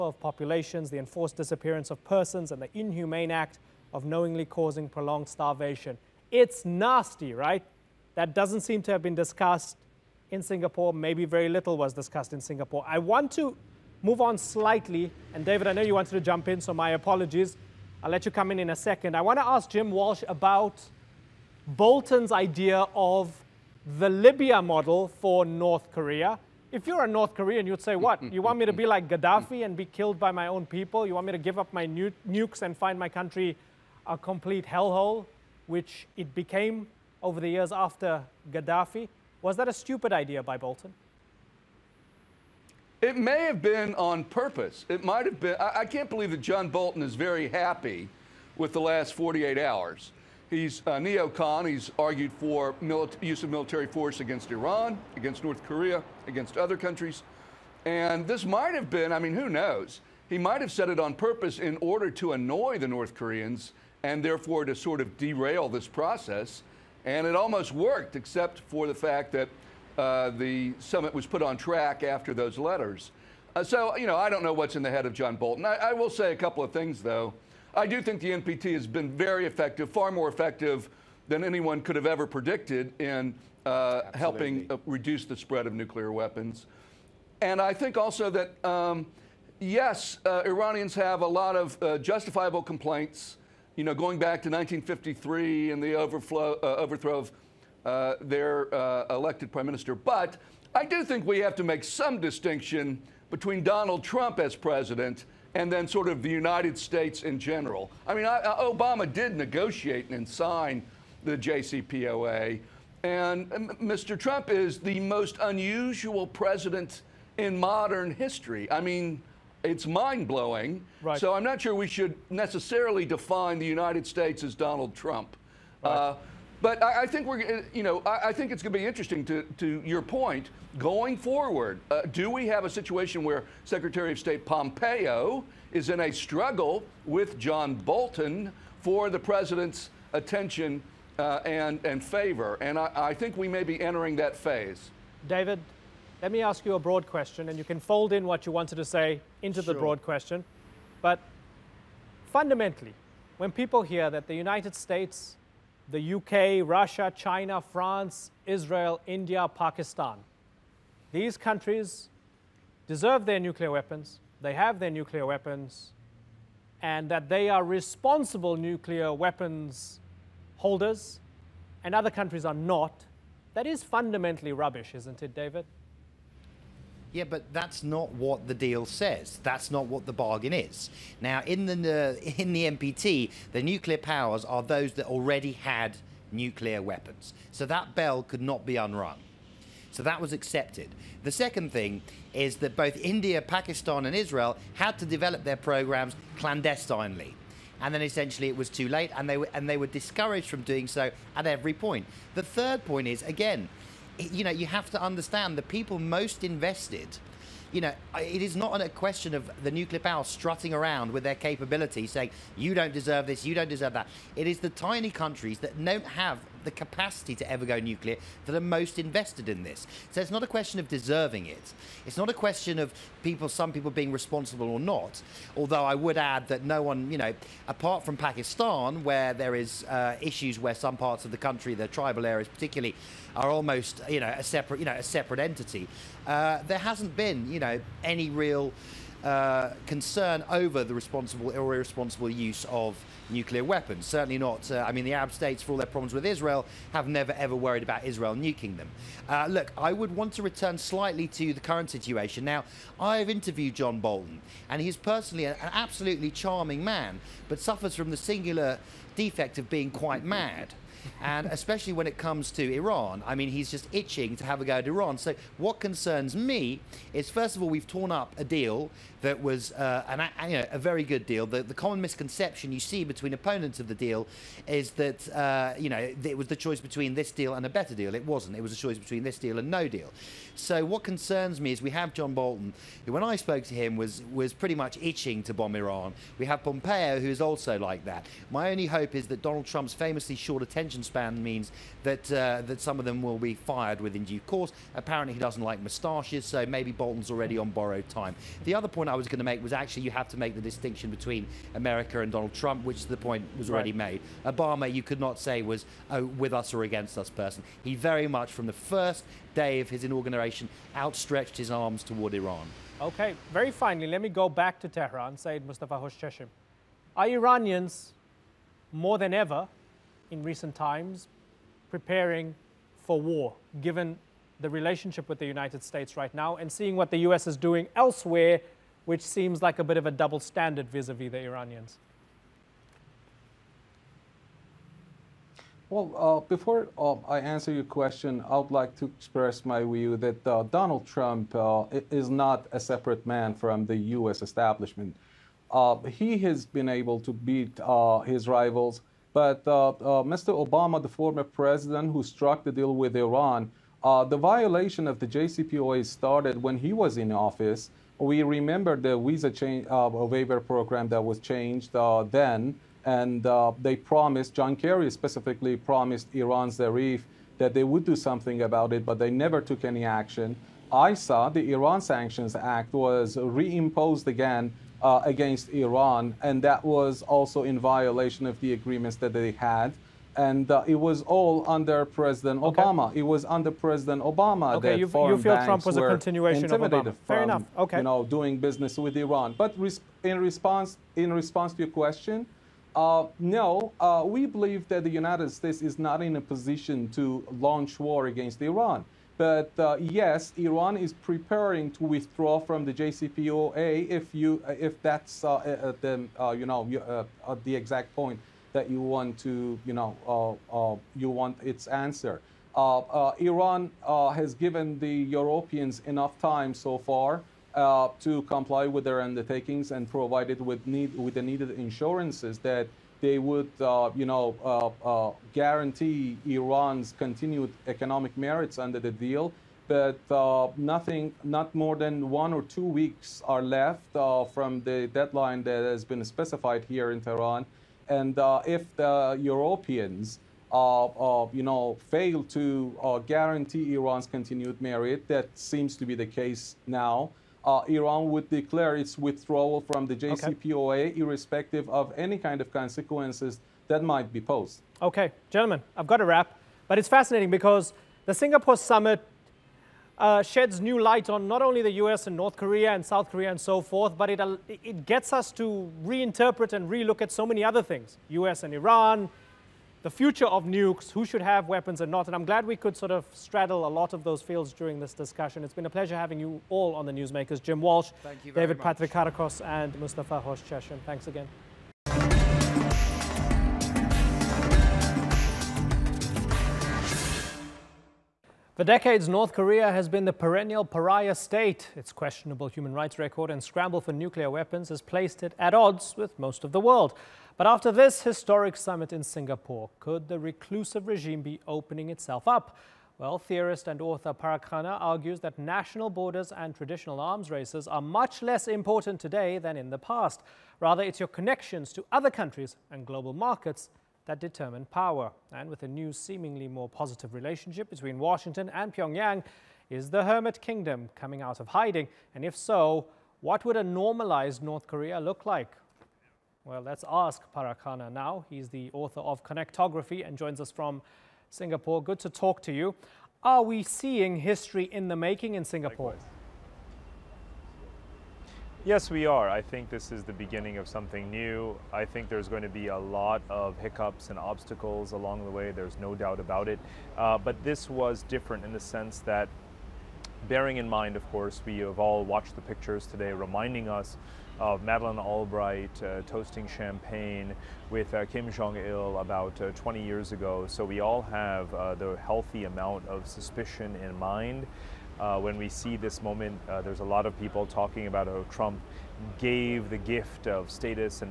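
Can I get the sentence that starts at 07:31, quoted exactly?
irrespective of any kind of consequences that might be posed.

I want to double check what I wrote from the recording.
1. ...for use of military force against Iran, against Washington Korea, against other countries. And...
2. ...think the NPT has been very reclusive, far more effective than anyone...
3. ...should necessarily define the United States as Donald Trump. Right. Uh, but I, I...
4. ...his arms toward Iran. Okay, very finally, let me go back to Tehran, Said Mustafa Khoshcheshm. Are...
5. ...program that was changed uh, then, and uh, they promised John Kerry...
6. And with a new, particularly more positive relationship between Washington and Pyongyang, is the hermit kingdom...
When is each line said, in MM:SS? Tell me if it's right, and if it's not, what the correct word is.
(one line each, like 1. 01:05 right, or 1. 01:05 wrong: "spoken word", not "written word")
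1. 00:52 wrong: "North", not "Washington"
2. 01:18 wrong: "effective", not "reclusive"
3. 02:01 right
4. 05:11 right
5. 06:00 right
6. 08:35 wrong: "seemingly", not "particularly".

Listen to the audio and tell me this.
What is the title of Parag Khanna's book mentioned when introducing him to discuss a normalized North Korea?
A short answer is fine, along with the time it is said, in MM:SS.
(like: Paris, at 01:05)
Connectography, at 08:49.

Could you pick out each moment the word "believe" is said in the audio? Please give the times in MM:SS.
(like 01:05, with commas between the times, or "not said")
00:46, 06:34.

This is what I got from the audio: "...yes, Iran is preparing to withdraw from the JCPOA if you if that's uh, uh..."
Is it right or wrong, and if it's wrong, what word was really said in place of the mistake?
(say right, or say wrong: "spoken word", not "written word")
right.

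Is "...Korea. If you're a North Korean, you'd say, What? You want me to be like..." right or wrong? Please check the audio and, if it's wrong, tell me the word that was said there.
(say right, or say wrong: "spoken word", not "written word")
right.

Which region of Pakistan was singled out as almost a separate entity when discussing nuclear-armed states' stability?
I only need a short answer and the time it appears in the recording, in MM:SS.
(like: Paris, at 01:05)
The tribal areas, at 03:51.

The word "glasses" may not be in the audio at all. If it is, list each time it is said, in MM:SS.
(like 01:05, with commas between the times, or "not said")
not said.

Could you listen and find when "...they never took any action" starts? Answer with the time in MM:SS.
06:09.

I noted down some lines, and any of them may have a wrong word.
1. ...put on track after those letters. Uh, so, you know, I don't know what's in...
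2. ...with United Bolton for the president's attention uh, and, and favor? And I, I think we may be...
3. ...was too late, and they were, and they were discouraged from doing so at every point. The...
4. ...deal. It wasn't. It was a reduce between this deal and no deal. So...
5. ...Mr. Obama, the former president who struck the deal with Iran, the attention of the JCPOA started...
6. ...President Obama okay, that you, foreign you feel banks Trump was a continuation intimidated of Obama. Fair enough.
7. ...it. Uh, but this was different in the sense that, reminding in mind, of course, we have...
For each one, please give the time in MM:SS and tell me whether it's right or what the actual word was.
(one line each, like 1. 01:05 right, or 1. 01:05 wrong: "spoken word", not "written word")
1. 01:11 right
2. 02:17 wrong: "John", not "United"
3. 03:18 right
4. 04:37 wrong: "choice", not "reduce"
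5. 05:49 wrong: "violation", not "attention"
6. 06:23 right
7. 09:06 wrong: "bearing", not "reminding".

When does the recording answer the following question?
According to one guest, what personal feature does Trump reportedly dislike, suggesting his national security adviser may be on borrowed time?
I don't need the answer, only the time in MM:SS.
04:55.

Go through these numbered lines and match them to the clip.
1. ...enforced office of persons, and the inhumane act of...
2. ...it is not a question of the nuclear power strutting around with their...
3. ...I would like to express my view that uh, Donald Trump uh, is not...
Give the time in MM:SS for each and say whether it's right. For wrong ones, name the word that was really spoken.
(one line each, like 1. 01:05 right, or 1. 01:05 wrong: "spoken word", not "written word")
1. 00:00 wrong: "disappearance", not "office"
2. 03:28 right
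3. 05:38 right.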